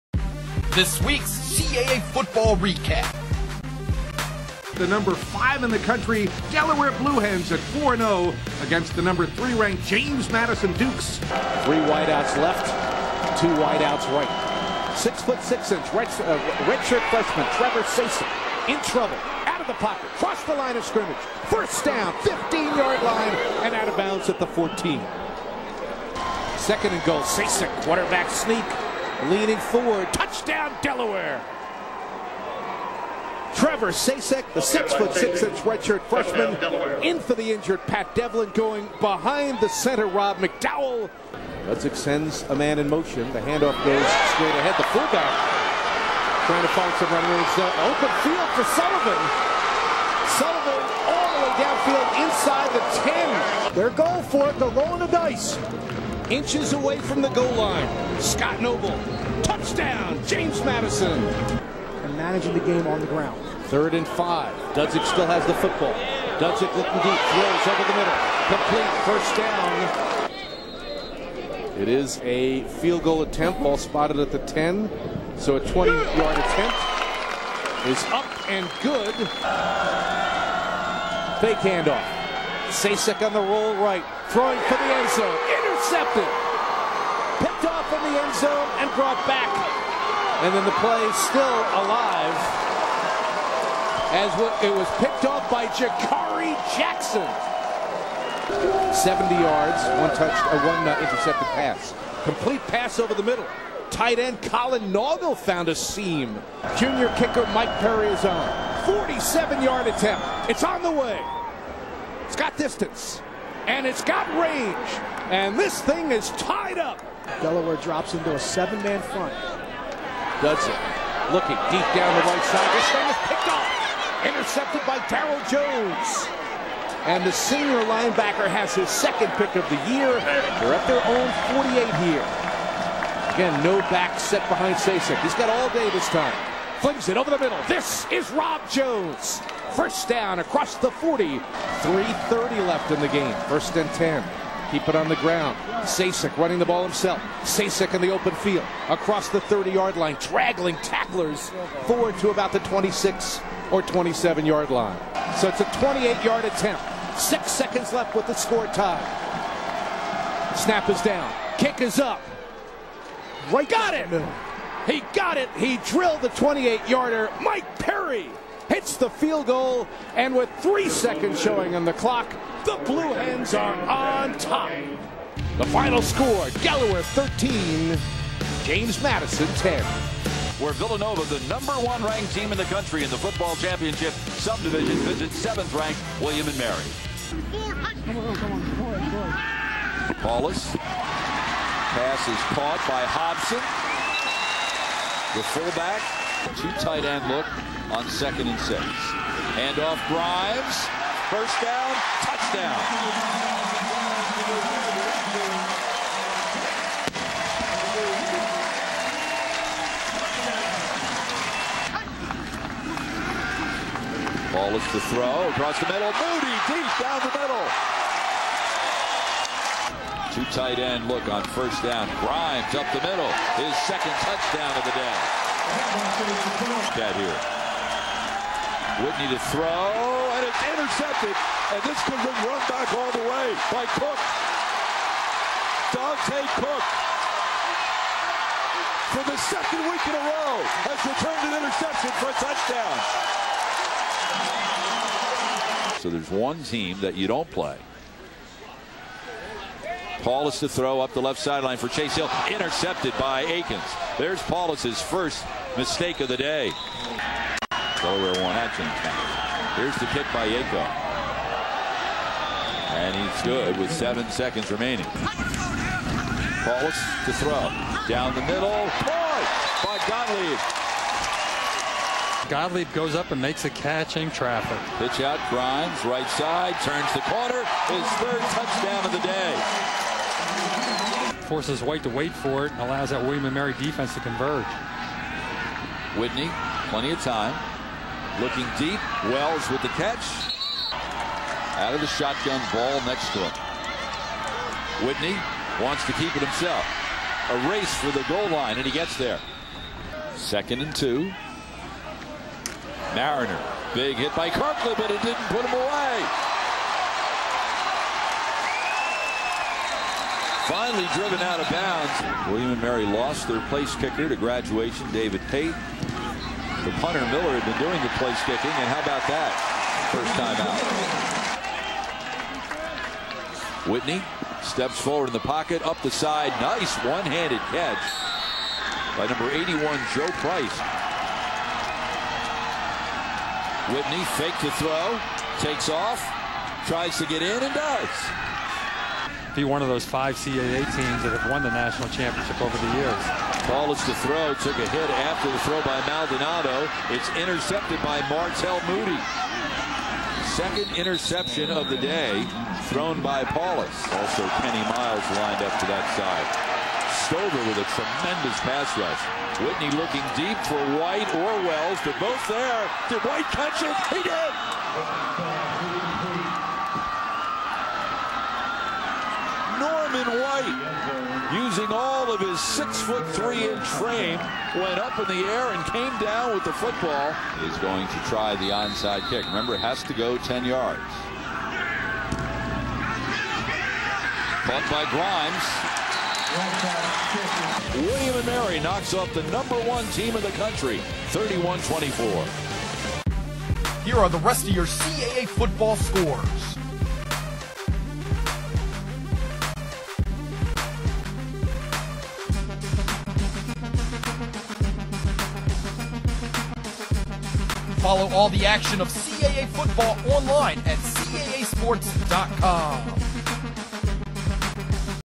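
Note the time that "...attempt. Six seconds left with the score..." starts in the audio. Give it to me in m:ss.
2:36.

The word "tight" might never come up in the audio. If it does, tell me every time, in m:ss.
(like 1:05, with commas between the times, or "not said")
1:43, 3:16, 3:40.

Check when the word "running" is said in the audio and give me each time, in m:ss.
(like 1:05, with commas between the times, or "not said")
0:47, 2:26.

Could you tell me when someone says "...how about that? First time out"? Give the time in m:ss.
5:18.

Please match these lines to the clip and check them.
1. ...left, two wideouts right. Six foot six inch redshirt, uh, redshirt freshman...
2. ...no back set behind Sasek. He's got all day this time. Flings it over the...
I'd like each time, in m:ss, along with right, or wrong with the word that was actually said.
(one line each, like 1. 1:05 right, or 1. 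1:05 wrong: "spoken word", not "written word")
1. 0:12 right
2. 2:13 right.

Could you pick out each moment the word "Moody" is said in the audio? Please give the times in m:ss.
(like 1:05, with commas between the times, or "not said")
3:36, 5:48.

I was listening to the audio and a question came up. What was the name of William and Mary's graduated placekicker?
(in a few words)
David Pate.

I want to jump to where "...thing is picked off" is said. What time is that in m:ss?
2:02.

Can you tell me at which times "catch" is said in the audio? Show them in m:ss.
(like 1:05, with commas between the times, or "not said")
4:33, 4:49, 5:27, 6:03.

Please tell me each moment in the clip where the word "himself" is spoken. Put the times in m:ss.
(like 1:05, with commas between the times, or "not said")
2:26, 4:56.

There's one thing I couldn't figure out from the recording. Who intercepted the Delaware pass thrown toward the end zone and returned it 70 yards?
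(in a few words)
Jakari Jackson.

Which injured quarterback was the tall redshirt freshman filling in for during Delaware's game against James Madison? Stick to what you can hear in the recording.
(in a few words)
Pat Devlin.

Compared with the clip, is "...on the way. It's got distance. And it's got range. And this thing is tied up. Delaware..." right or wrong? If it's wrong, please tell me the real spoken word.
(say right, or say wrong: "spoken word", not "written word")
right.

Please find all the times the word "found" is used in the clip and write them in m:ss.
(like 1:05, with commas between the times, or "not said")
1:45.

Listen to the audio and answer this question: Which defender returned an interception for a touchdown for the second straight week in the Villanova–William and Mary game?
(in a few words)
Dante Cook.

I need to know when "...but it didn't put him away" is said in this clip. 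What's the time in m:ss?
5:04.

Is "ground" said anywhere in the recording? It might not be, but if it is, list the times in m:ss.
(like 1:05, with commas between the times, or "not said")
1:03, 2:25.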